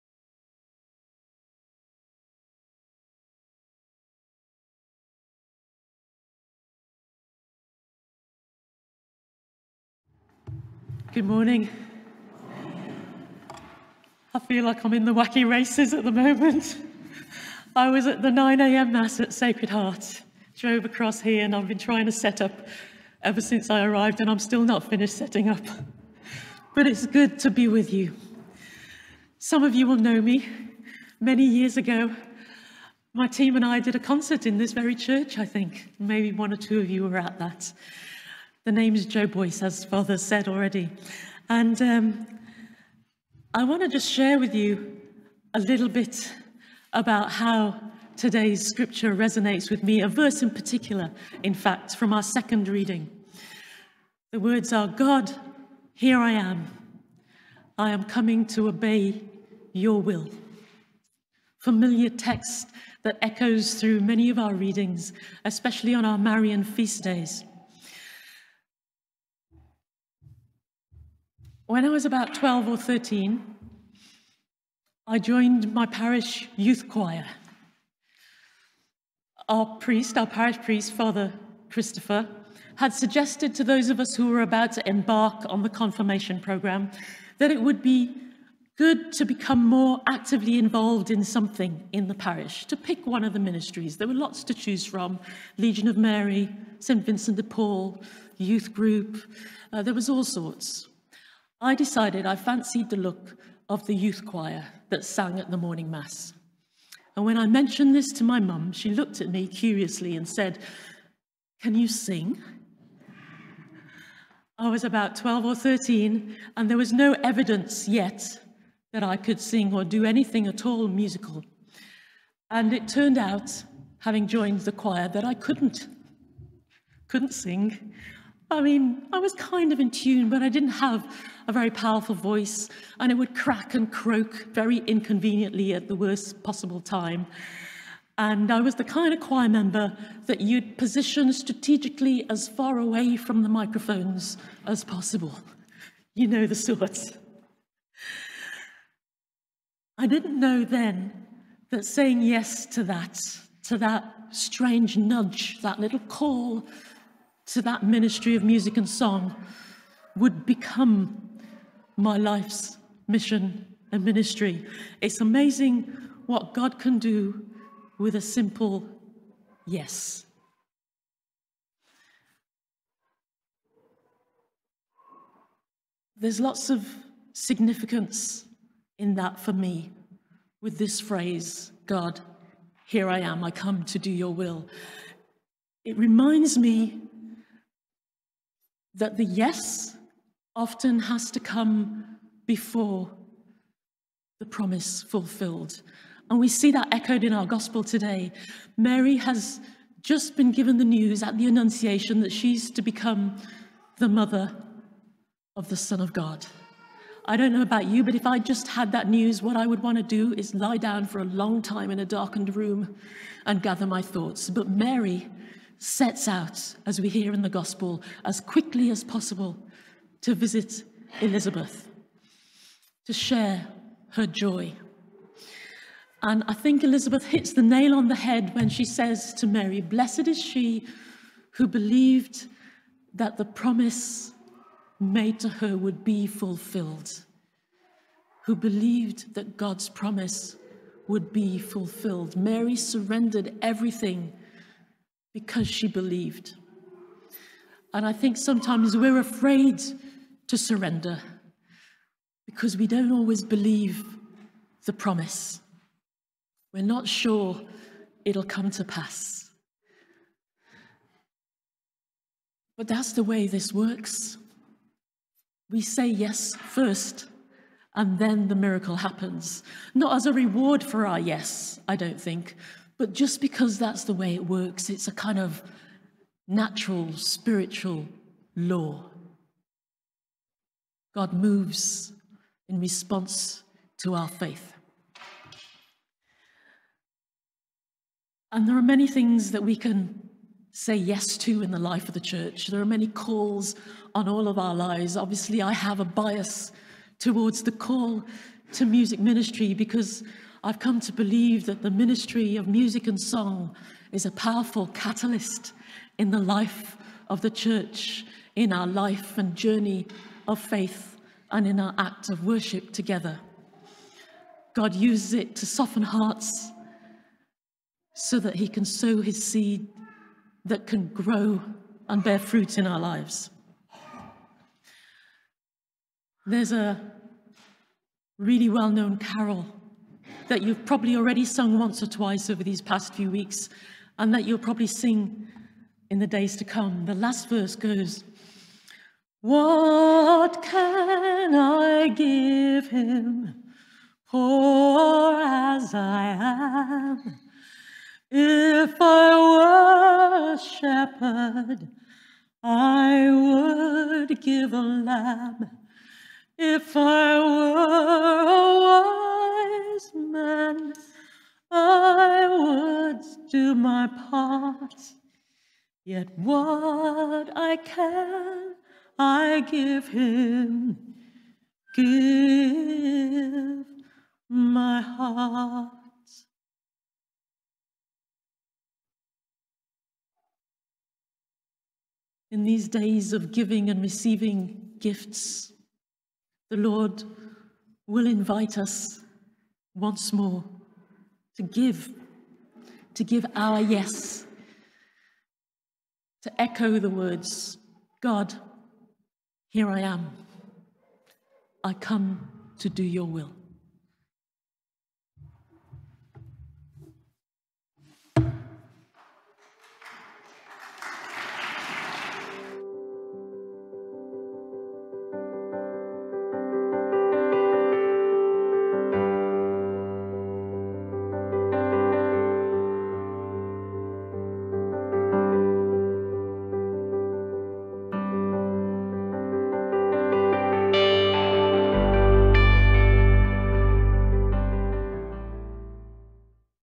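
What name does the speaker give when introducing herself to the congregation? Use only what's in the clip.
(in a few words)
Jo Boyce.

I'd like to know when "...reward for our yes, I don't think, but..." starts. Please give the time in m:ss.
4:30.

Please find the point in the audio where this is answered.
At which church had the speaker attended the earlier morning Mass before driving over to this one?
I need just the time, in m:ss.
0:19.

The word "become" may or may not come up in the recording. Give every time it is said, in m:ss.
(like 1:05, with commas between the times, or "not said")
1:29, 2:40, 3:22.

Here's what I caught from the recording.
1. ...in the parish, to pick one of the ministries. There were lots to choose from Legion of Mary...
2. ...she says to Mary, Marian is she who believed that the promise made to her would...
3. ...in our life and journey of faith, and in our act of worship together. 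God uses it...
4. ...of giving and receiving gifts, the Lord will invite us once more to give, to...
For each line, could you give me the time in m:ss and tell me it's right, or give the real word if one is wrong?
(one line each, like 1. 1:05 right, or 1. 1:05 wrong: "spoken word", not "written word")
1. 1:31 right
2. 3:48 wrong: "Blessed", not "Marian"
3. 5:08 right
4. 6:23 right.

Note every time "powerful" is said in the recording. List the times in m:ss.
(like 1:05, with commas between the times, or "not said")
2:11, 5:04.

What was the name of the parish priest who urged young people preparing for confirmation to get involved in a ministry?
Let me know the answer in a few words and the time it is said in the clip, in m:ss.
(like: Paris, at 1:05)
Father Christopher, at 1:20.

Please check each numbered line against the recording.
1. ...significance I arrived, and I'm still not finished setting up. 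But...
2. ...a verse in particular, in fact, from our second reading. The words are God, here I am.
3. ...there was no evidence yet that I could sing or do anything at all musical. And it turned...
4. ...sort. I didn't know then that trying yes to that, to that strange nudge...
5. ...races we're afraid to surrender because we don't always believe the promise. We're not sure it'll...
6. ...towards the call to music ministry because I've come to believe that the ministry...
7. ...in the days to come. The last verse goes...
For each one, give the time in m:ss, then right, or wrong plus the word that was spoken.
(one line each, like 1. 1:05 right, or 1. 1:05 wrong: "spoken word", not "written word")
1. 0:23 wrong: "since", not "significance"
2. 0:50 right
3. 1:56 right
4. 2:26 wrong: "saying", not "trying"
5. 4:08 wrong: "sometimes", not "races"
6. 4:57 right
7. 5:36 right.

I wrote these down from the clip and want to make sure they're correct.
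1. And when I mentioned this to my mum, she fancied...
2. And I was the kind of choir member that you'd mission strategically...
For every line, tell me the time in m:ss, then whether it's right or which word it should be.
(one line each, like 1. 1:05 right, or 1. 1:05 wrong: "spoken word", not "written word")
1. 1:47 wrong: "looked", not "fancied"
2. 2:18 wrong: "position", not "mission".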